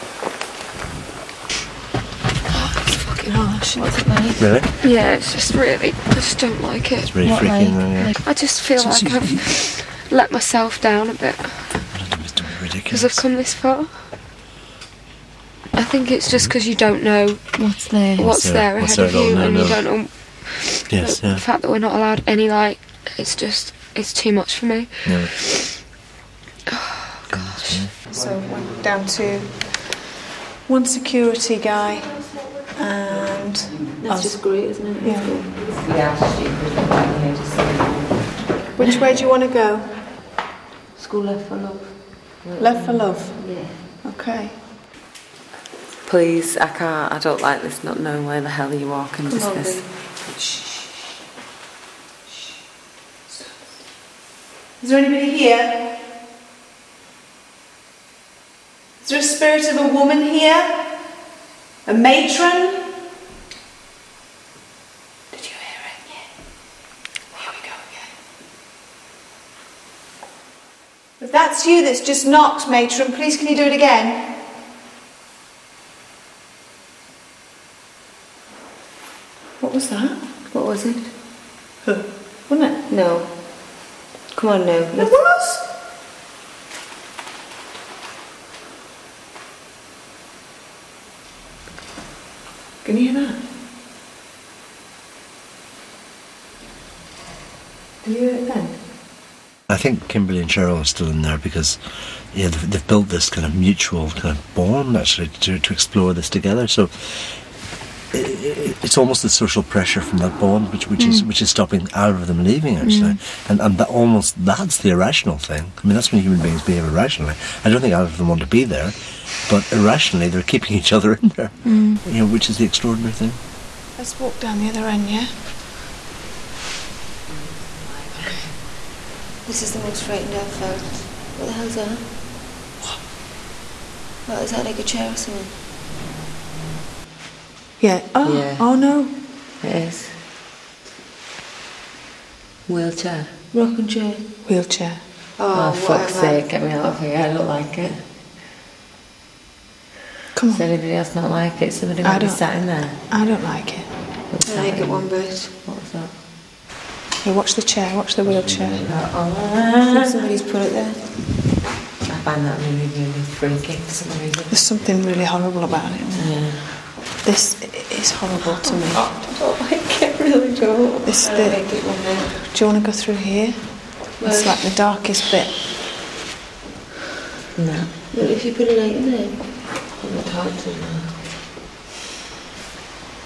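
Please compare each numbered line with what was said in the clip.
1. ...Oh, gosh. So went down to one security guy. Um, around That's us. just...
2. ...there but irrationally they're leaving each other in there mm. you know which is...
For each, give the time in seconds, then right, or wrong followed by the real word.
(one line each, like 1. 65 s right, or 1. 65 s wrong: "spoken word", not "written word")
1. 26 s right
2. 118 s wrong: "keeping", not "leaving".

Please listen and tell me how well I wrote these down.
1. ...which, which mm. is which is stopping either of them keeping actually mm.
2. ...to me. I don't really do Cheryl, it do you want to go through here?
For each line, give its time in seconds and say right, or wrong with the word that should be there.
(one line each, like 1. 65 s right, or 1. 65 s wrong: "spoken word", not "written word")
1. 110 s wrong: "leaving", not "keeping"
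2. 168 s wrong: "This", not "Cheryl".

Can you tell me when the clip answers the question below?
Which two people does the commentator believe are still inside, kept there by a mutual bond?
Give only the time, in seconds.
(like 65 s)
100 s.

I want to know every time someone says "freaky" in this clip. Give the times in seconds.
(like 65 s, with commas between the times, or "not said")
7 s, 163 s.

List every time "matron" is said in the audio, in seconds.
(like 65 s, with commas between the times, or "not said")
61 s, 72 s.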